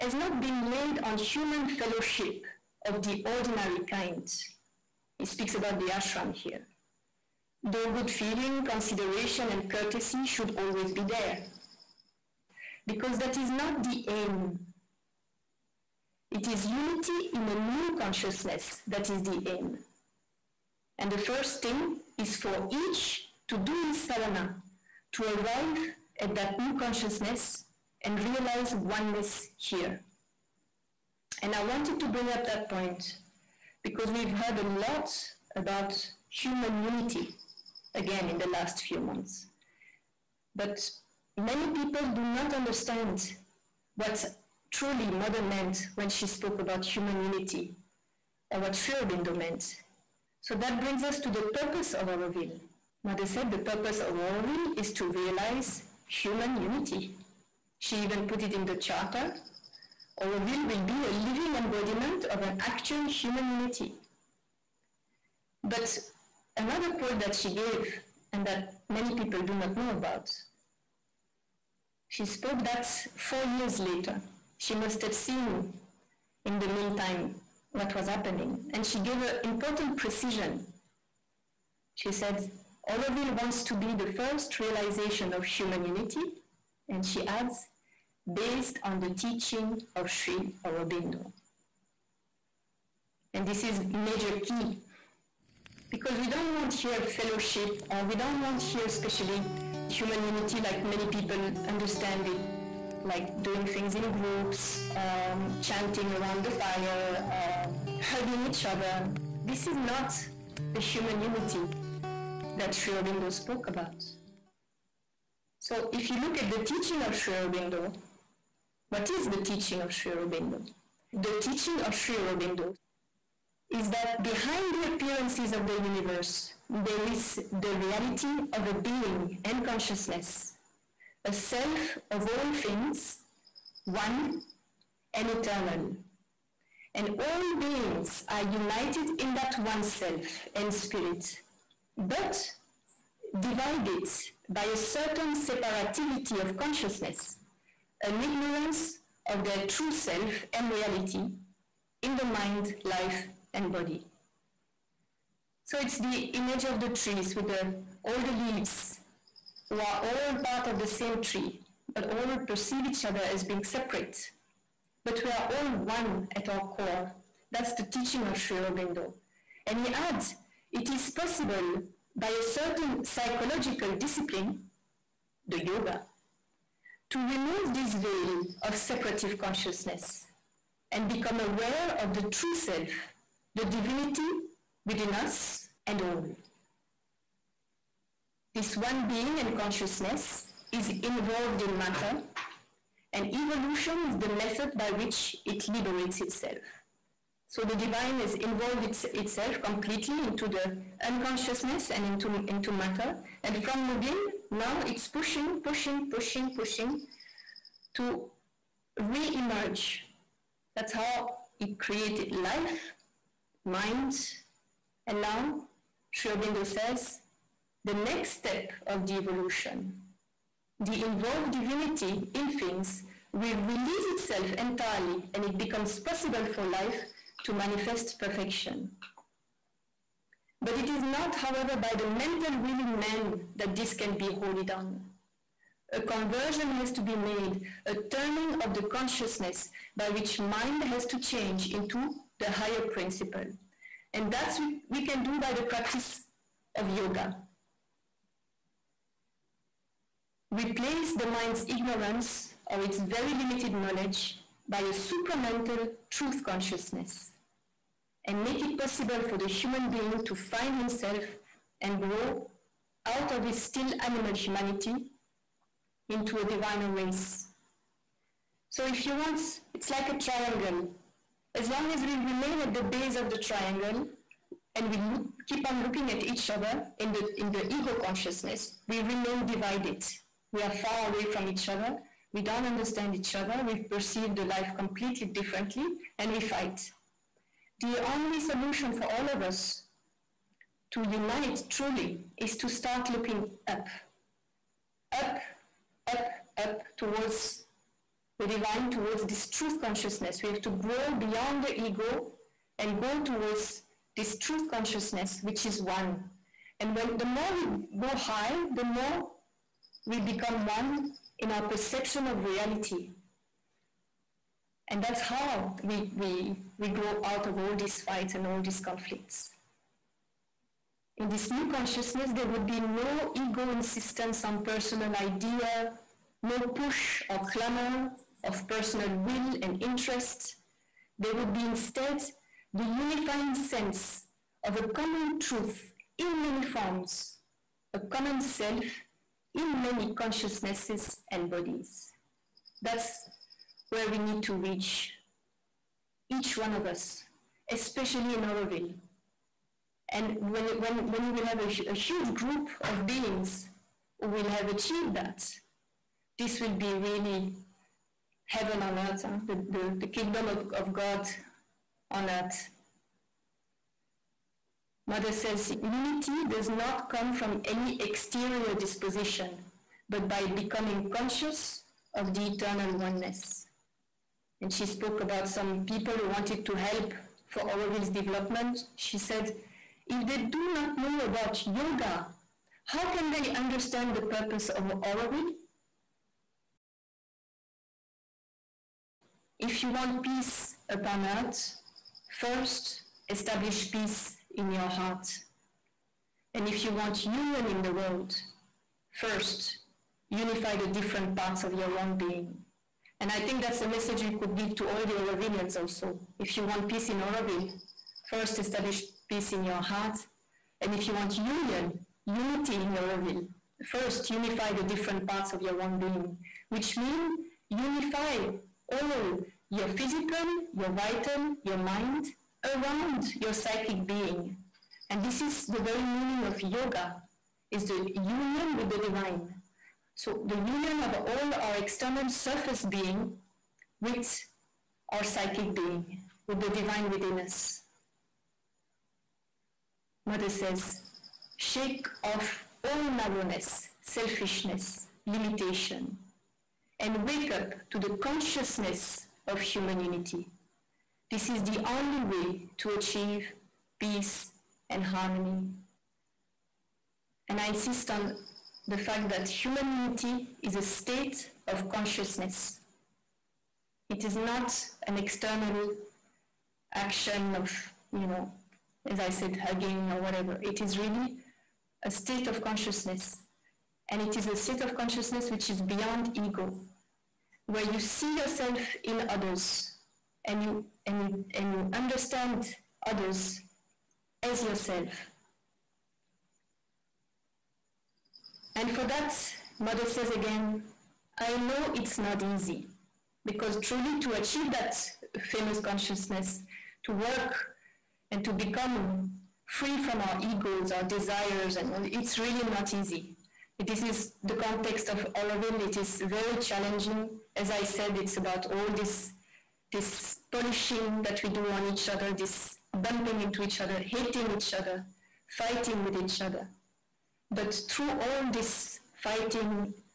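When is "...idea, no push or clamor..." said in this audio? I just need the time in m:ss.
5:25.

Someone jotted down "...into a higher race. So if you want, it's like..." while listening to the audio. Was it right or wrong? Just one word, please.
wrong.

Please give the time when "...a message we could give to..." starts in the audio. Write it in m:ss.
6:43.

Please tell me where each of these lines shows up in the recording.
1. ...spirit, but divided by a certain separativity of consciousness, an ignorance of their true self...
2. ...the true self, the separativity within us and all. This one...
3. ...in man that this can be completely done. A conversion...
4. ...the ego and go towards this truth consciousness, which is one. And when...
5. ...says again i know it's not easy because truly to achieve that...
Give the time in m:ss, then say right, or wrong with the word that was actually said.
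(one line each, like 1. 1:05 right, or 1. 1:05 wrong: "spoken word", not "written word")
1. 2:20 right
2. 3:02 wrong: "divinity", not "separativity"
3. 3:52 wrong: "wholly", not "completely"
4. 5:01 right
5. 8:10 right.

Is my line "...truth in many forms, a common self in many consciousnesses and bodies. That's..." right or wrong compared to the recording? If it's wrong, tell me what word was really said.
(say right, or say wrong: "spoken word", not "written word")
right.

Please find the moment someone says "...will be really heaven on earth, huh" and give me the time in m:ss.
5:56.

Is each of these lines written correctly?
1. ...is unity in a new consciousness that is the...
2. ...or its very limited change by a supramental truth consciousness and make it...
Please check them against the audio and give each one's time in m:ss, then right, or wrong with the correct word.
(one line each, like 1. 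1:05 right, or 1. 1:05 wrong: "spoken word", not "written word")
1. 0:16 right
2. 4:12 wrong: "knowledge", not "change".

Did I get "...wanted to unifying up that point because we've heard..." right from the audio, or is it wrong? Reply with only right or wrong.
wrong.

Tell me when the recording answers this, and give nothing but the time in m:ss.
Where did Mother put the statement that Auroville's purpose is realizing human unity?
0:58.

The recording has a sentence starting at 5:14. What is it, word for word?
And that's how we, we, we grow out of all these fights and all these conflicts.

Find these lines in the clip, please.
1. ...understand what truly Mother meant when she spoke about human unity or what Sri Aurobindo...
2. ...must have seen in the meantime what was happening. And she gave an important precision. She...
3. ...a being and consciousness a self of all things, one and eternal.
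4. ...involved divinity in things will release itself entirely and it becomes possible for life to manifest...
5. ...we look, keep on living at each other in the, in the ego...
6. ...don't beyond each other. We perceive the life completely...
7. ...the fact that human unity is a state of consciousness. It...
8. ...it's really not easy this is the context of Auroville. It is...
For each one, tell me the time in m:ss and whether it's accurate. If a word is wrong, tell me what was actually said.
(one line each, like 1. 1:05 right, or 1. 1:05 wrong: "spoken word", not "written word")
1. 0:42 right
2. 1:14 right
3. 2:08 right
4. 3:41 right
5. 4:34 wrong: "looking", not "living"
6. 4:42 wrong: "understand", not "beyond"
7. 7:38 right
8. 8:22 right.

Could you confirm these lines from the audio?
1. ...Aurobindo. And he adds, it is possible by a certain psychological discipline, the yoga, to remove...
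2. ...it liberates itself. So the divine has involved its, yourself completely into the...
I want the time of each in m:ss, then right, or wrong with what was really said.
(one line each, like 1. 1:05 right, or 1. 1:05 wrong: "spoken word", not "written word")
1. 2:48 right
2. 3:15 wrong: "itself", not "yourself".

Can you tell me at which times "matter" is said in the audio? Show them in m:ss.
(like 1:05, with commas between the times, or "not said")
3:11, 3:22.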